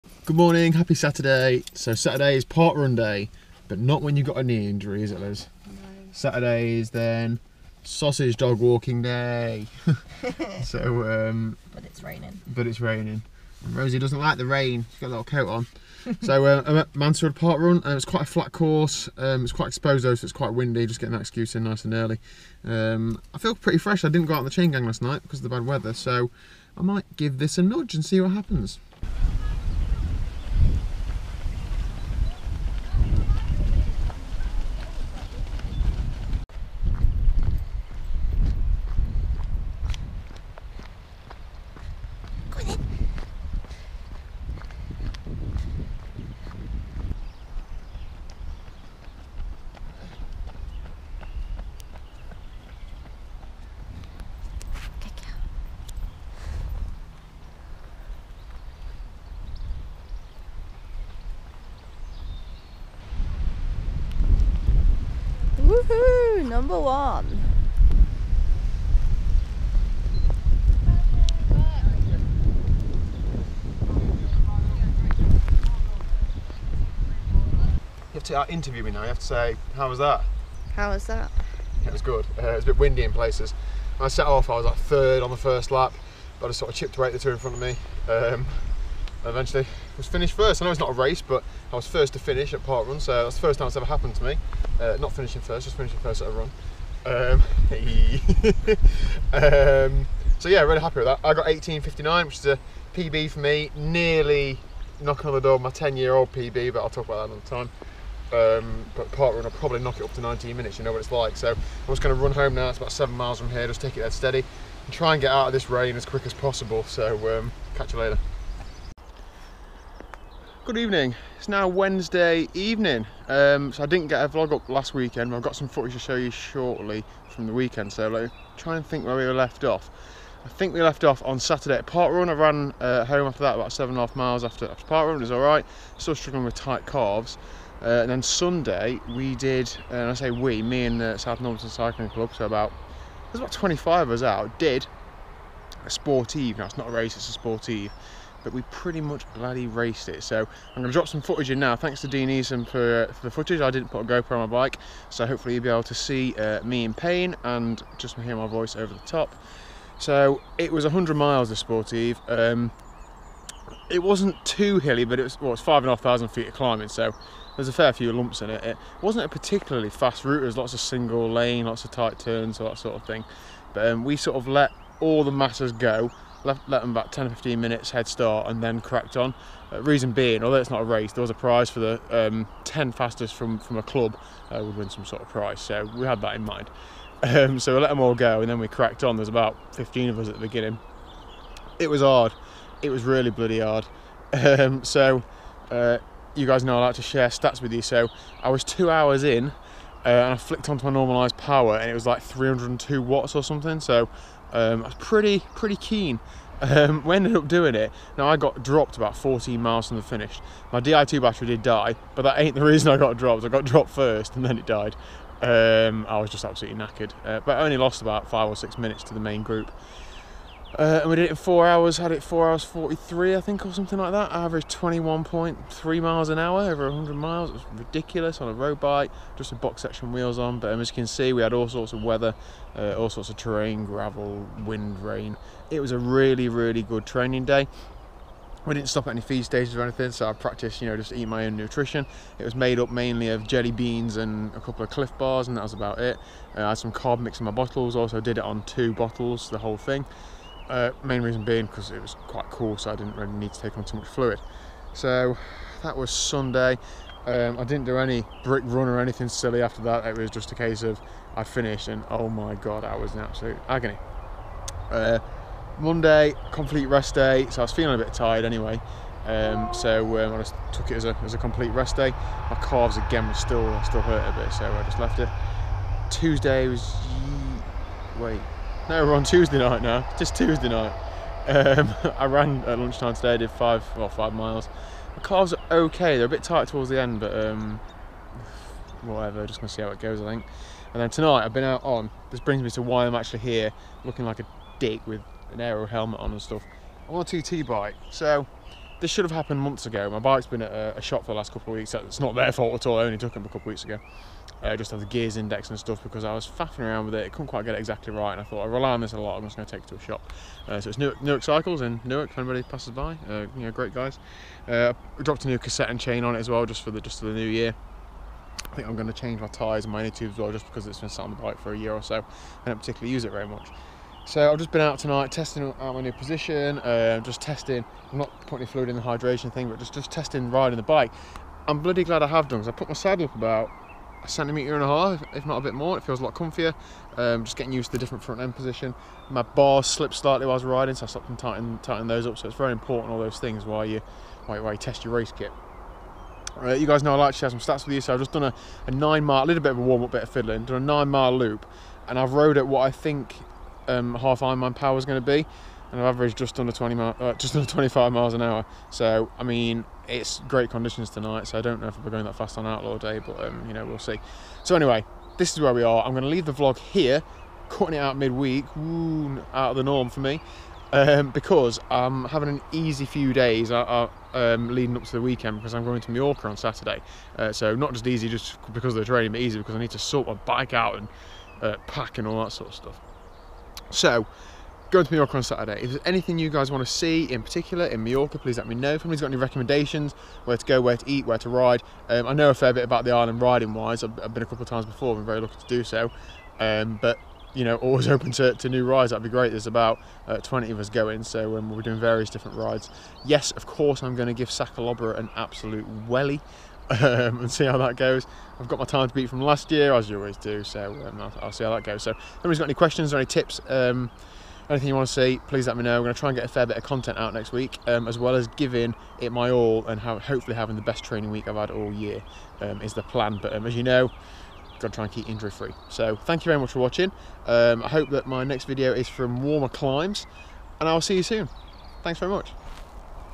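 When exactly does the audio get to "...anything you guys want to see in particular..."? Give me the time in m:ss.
6:26.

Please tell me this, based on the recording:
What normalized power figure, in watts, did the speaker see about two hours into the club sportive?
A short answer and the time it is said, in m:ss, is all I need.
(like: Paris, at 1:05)
302, at 3:22.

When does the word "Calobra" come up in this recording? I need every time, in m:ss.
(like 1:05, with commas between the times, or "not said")
6:44.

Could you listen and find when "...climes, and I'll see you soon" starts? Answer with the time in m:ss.
7:09.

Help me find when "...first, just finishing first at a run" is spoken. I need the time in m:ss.
1:35.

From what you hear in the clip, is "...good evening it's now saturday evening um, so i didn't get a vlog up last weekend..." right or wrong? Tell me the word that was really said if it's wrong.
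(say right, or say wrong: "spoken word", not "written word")
wrong: "wednesday", not "saturday".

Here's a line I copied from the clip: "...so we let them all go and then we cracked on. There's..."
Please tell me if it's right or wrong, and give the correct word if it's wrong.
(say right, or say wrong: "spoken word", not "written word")
right.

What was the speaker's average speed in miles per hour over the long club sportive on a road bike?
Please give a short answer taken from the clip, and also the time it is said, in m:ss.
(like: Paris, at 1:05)
21.3, at 3:45.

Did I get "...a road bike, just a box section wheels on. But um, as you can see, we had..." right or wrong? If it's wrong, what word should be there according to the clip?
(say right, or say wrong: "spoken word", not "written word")
right.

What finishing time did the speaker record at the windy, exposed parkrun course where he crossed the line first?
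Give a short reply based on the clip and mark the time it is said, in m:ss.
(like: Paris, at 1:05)
18:59, at 1:41.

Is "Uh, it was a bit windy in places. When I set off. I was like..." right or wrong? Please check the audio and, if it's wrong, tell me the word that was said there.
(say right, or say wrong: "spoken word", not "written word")
right.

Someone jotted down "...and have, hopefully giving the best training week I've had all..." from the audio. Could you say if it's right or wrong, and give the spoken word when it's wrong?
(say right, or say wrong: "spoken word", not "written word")
wrong: "having", not "giving".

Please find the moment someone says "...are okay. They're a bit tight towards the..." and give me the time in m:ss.
4:45.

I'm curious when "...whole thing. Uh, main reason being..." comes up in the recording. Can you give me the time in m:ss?
4:09.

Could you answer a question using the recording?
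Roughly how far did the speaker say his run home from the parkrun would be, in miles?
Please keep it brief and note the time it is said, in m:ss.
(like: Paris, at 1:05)
7, at 1:52.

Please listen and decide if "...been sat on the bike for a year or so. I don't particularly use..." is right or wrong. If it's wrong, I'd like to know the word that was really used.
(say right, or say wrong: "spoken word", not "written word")
right.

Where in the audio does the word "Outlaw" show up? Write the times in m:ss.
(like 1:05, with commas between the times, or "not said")
6:02.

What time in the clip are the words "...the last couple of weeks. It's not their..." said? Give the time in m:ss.
5:01.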